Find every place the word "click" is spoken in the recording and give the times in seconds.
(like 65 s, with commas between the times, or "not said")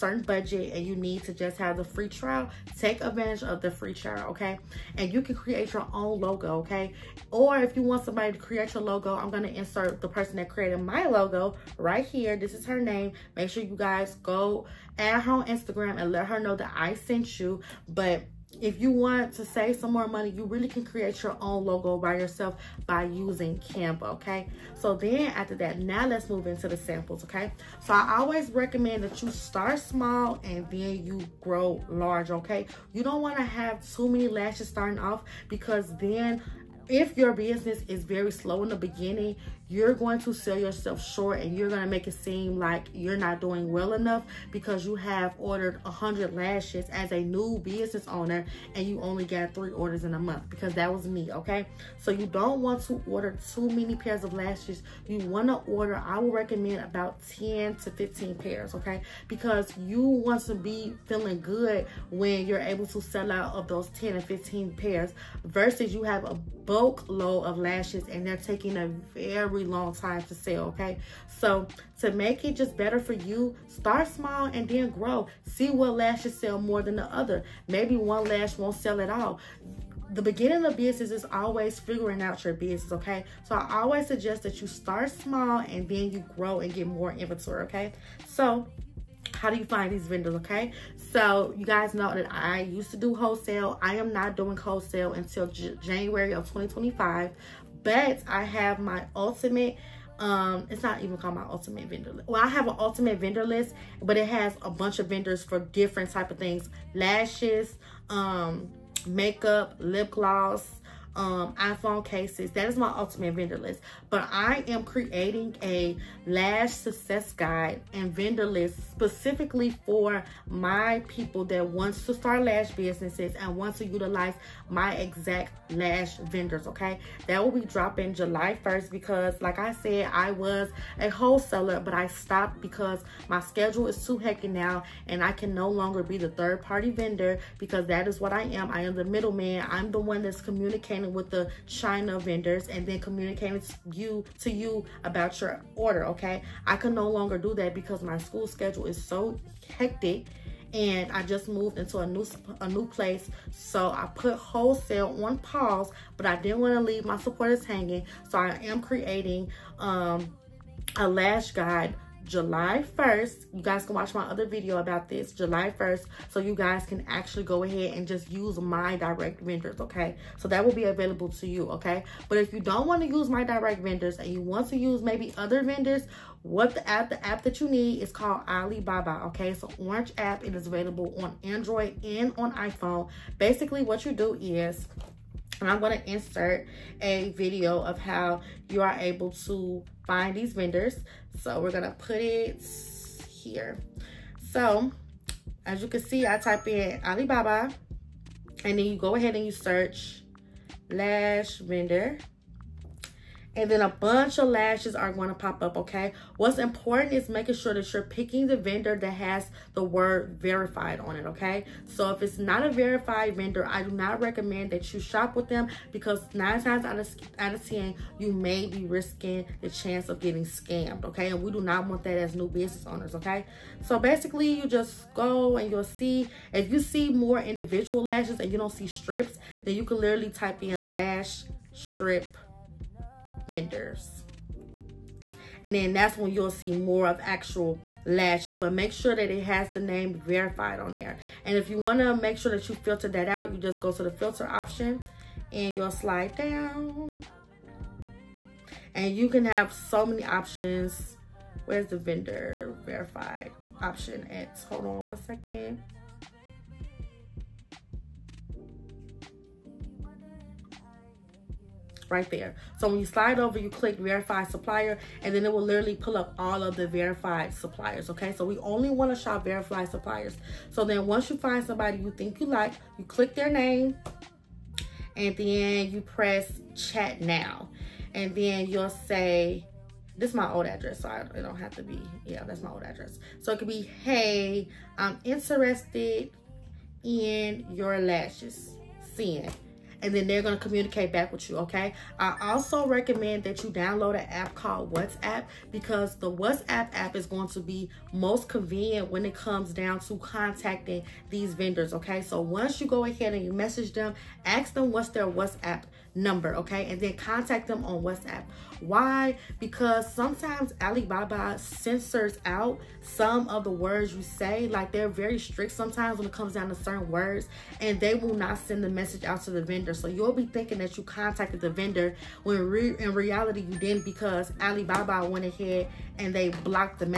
263 s, 273 s.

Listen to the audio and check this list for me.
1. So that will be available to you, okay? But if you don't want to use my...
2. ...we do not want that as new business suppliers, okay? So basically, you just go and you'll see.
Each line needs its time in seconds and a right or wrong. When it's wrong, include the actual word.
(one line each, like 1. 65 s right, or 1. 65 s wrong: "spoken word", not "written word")
1. 170 s right
2. 221 s wrong: "owners", not "suppliers".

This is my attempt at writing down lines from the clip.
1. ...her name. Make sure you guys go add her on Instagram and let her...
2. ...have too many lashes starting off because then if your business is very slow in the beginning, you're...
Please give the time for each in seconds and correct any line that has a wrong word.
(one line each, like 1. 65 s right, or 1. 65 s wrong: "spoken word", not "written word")
1. 12 s right
2. 33 s right.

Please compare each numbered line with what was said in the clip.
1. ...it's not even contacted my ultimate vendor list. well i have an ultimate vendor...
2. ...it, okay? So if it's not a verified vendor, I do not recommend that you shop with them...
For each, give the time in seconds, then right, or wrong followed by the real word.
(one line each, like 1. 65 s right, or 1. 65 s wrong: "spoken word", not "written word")
1. 100 s wrong: "called", not "contacted"
2. 211 s right.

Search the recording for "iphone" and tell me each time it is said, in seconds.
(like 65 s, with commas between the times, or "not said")
111 s, 182 s.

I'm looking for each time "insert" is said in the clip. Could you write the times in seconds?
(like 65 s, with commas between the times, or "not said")
9 s, 186 s.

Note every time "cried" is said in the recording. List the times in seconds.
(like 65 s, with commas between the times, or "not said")
not said.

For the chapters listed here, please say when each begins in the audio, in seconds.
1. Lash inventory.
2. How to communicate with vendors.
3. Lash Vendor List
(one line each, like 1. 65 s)
1. 27 s
2. 186 s
3. 93 s.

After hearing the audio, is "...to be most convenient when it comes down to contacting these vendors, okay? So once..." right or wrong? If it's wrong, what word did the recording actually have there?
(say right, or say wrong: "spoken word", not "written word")
right.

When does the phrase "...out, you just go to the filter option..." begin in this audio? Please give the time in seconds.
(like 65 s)
243 s.